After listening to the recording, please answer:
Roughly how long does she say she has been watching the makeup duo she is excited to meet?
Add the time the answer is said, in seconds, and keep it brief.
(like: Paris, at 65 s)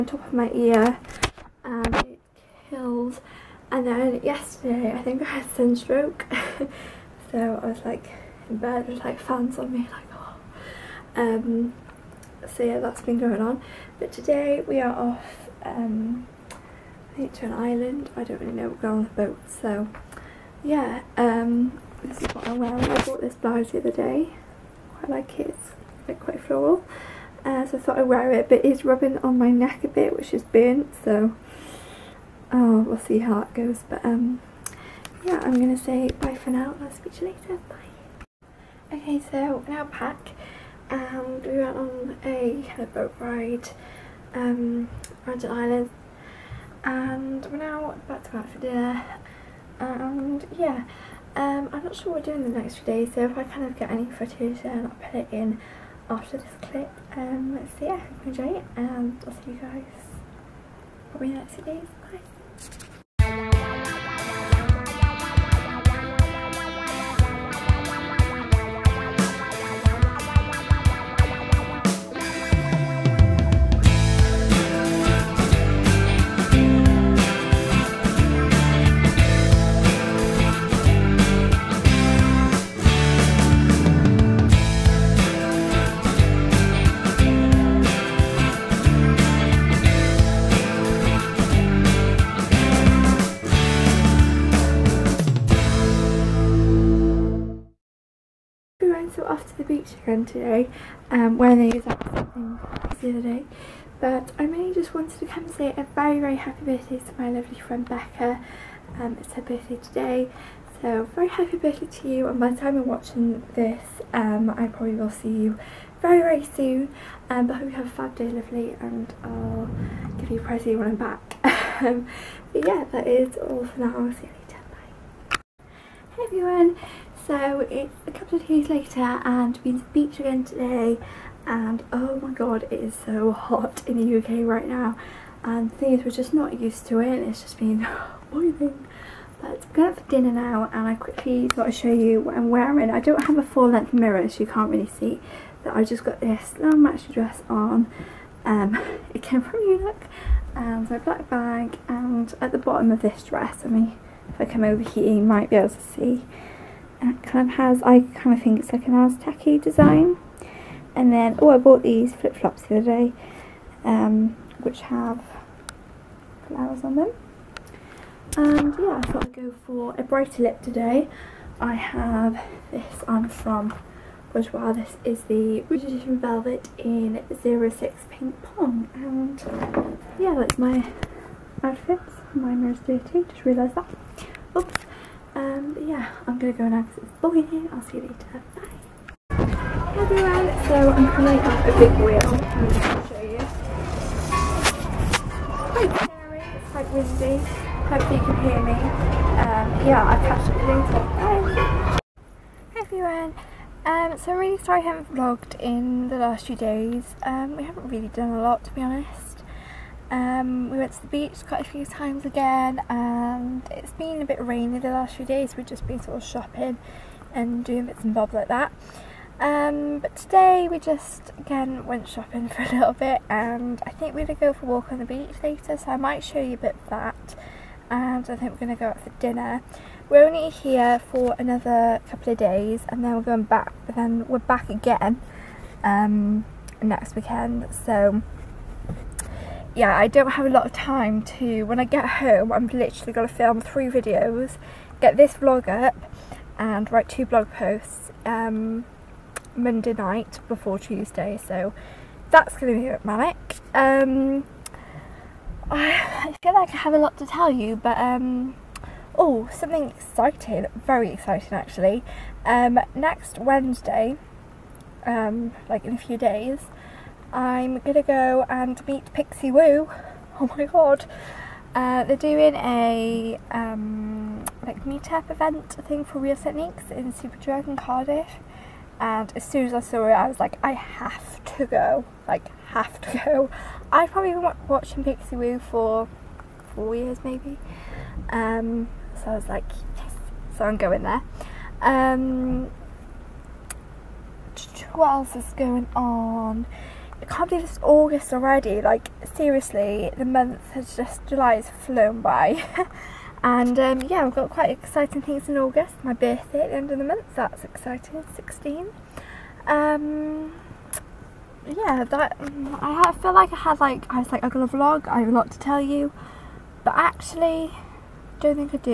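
4 years, at 286 s.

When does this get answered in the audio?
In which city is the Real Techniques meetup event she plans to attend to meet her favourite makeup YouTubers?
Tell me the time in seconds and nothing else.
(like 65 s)
277 s.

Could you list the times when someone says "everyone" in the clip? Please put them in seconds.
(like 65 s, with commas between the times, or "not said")
126 s, 189 s, 202 s.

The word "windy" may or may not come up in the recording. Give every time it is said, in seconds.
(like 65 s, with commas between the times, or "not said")
196 s.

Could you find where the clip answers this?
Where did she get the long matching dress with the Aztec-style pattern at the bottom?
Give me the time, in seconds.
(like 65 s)
149 s.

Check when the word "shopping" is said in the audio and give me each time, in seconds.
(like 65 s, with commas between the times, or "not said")
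216 s, 222 s.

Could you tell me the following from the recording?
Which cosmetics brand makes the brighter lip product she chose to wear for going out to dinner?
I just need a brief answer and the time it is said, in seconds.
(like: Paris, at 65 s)
Bourjois, at 174 s.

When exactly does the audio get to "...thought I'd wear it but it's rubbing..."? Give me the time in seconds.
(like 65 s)
27 s.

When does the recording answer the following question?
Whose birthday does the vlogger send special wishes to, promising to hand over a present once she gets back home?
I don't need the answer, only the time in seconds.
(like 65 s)
107 s.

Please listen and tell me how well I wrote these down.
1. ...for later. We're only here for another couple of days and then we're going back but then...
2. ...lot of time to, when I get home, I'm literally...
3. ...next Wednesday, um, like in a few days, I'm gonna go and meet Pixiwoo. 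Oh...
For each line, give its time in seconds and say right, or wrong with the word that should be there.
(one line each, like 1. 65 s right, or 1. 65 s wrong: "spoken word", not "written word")
1. 229 s wrong: "dinner", not "later"
2. 240 s right
3. 262 s right.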